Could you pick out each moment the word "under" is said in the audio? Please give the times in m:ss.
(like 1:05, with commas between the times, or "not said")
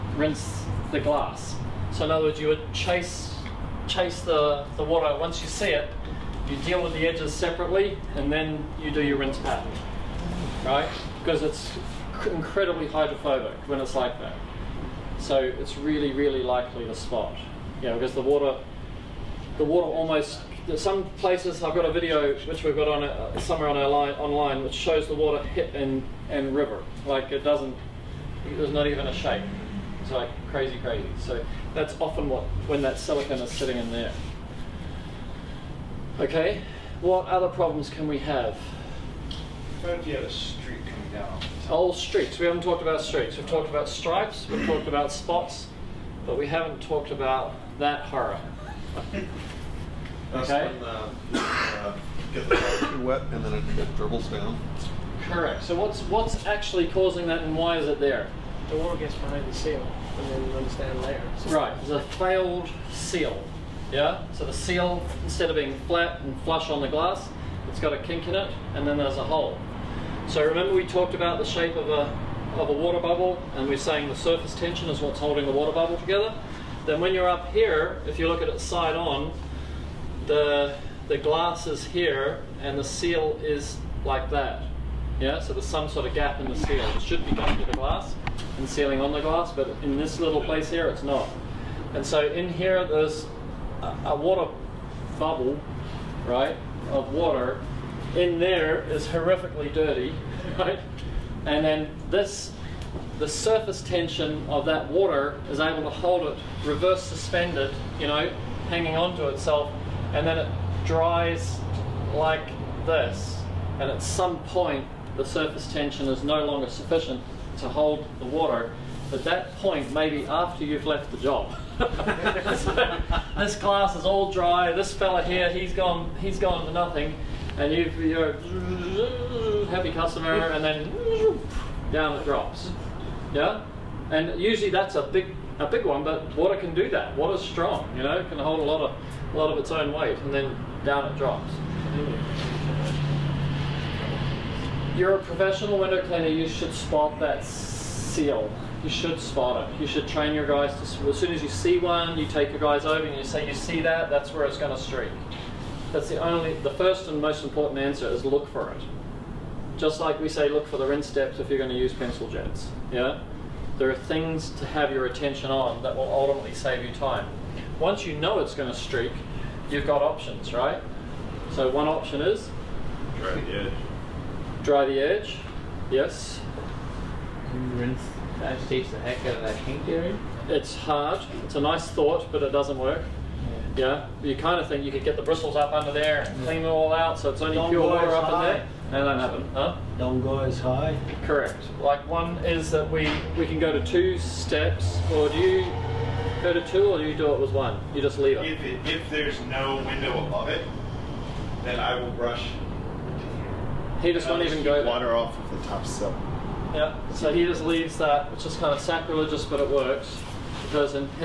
3:05.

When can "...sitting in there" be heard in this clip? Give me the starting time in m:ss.
0:33.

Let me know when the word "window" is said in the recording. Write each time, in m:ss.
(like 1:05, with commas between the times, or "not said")
2:25, 3:19.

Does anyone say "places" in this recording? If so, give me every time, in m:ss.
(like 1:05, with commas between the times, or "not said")
0:21, 1:30.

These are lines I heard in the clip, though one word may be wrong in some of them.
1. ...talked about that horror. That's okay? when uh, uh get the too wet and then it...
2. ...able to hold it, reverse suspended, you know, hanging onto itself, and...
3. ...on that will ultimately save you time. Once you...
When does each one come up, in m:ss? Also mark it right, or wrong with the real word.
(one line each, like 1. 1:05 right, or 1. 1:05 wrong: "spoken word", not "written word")
1. 0:46 right
2. 1:45 right
3. 2:45 right.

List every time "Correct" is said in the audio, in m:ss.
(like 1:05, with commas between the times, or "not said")
0:55, 3:11.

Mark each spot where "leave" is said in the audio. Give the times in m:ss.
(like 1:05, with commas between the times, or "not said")
3:18, 3:27.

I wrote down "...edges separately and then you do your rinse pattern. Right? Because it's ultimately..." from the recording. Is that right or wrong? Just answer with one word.
wrong.